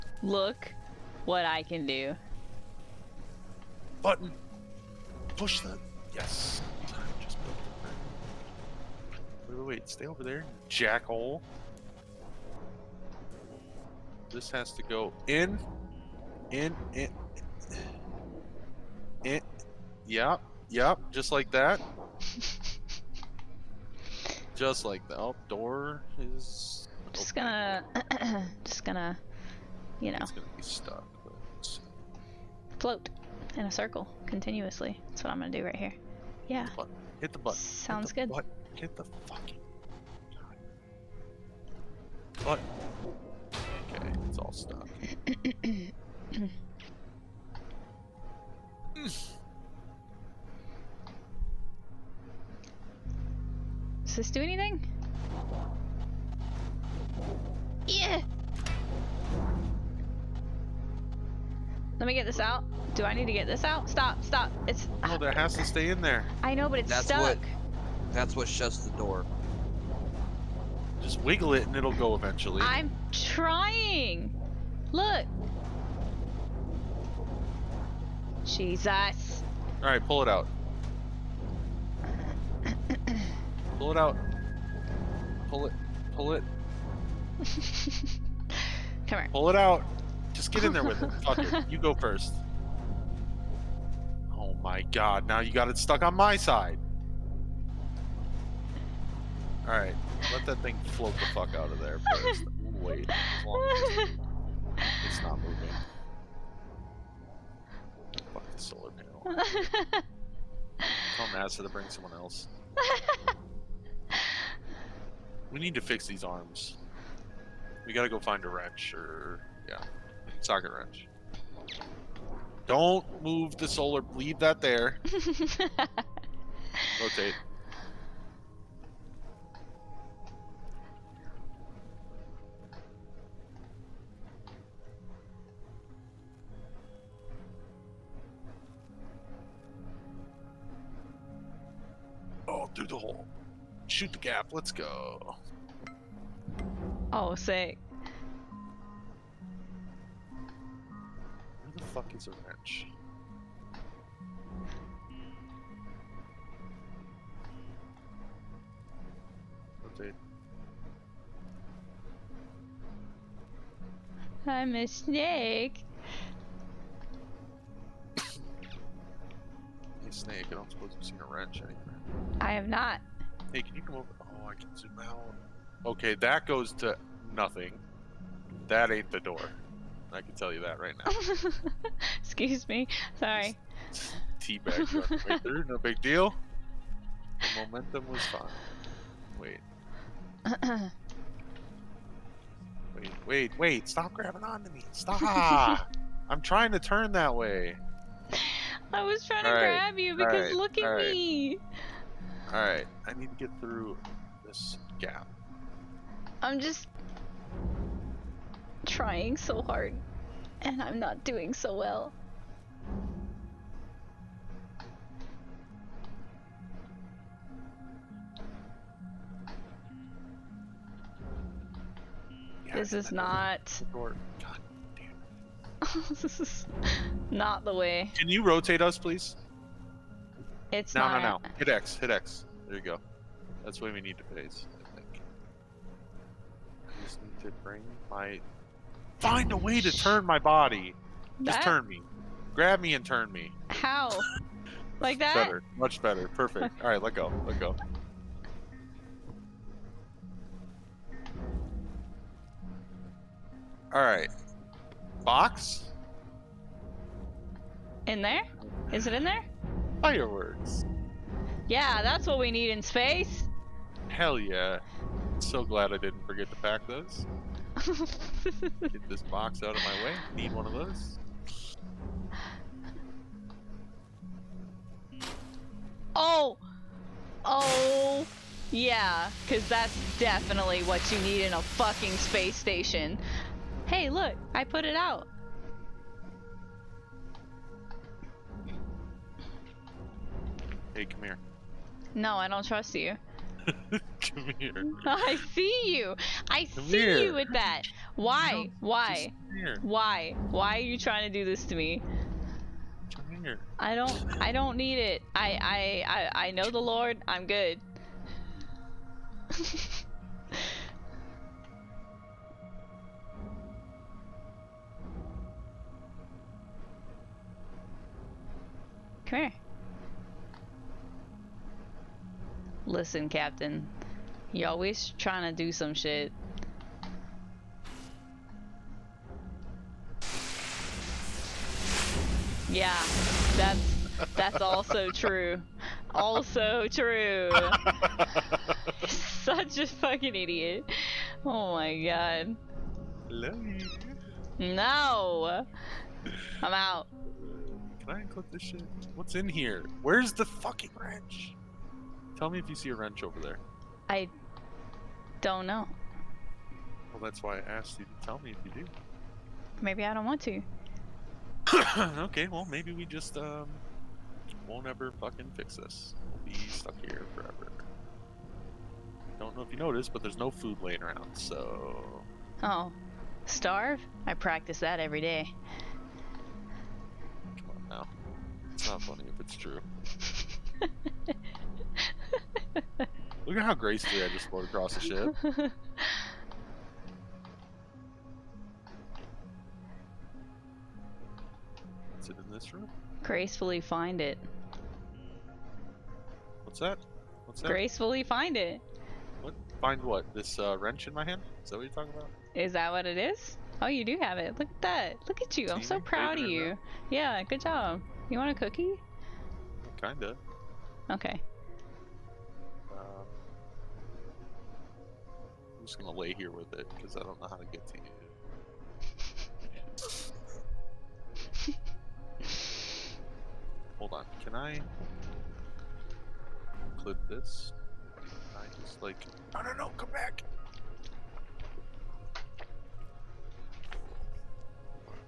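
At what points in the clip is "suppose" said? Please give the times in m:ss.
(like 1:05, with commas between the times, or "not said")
2:50.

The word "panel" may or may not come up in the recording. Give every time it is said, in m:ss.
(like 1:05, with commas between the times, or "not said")
1:48.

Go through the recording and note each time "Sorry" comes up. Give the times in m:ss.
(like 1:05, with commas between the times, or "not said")
3:03.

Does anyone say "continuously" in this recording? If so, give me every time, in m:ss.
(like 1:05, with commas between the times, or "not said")
0:34.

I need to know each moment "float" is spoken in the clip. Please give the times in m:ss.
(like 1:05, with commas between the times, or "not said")
0:32, 1:40, 6:24.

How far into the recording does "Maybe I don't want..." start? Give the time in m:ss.
5:59.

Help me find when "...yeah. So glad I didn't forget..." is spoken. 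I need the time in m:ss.
4:24.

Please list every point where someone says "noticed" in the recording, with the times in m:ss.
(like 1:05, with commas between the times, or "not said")
6:09.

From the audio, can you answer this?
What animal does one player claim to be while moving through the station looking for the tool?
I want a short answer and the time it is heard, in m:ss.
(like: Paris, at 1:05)
A snake, at 2:44.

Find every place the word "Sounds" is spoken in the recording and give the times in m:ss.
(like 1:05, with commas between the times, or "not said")
0:37.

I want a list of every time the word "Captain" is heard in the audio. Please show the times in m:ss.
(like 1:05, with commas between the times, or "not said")
5:23.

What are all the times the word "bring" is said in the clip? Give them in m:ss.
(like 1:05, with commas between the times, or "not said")
1:51, 3:57.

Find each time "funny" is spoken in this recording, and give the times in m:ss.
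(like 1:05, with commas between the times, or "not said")
6:19.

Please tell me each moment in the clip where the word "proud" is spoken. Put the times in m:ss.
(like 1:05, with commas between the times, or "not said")
6:45.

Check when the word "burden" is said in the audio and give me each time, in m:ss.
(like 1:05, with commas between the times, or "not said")
not said.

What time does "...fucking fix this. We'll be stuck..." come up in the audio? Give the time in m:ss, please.
6:05.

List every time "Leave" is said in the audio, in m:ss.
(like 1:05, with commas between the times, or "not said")
2:04.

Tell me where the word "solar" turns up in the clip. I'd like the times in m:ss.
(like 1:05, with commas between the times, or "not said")
1:48, 2:03.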